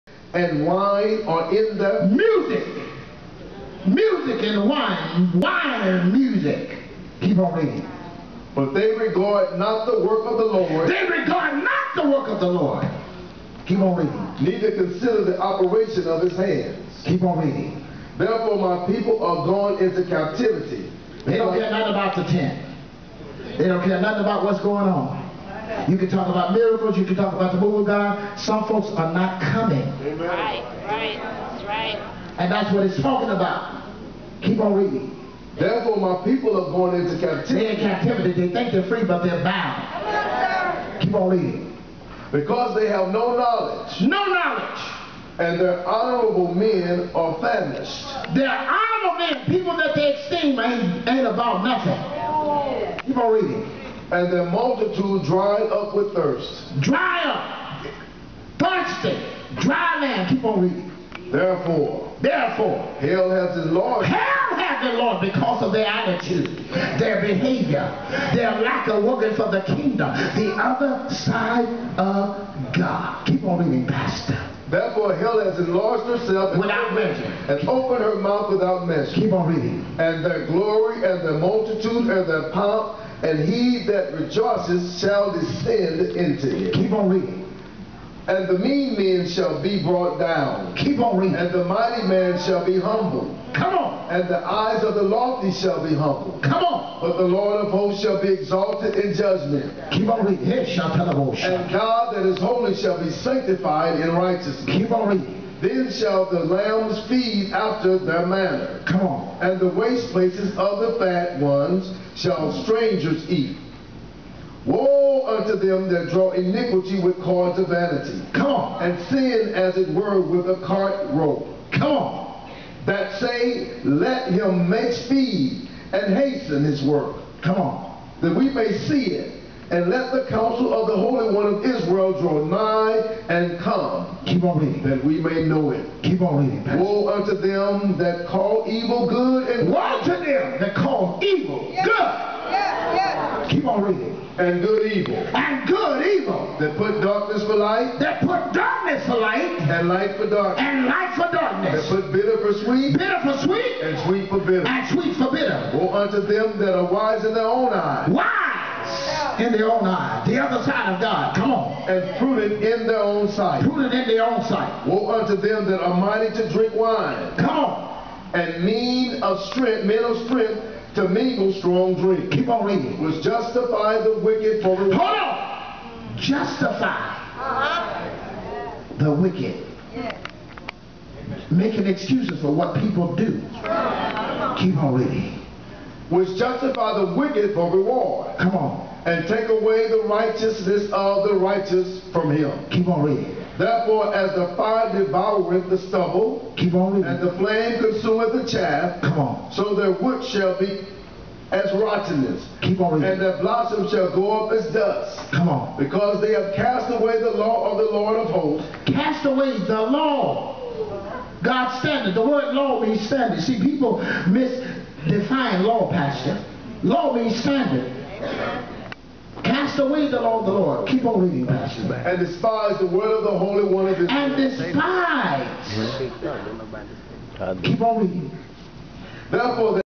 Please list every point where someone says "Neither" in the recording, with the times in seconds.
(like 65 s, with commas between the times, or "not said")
14 s.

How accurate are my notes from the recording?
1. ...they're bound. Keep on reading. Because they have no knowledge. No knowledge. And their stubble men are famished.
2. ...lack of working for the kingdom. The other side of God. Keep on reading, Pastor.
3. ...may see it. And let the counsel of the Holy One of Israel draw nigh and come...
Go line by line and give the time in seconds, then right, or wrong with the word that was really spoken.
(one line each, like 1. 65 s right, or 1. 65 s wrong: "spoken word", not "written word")
1. 39 s wrong: "honorable", not "stubble"
2. 68 s right
3. 128 s right.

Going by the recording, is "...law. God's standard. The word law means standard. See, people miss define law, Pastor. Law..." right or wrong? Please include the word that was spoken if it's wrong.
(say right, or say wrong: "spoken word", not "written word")
right.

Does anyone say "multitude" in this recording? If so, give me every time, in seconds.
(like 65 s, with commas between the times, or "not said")
54 s, 81 s.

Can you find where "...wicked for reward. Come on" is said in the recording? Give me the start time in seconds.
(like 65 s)
187 s.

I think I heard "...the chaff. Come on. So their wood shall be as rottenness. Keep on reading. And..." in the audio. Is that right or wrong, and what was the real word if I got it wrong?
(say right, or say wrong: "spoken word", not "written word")
right.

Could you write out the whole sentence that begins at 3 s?
Music and wine, wine and music.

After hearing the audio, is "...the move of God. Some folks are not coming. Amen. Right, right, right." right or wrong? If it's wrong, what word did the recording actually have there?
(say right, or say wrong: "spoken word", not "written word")
right.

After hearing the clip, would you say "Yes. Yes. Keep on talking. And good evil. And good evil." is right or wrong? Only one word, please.
wrong.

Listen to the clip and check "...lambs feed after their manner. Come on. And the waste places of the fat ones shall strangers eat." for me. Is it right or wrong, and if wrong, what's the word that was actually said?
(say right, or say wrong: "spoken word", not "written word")
right.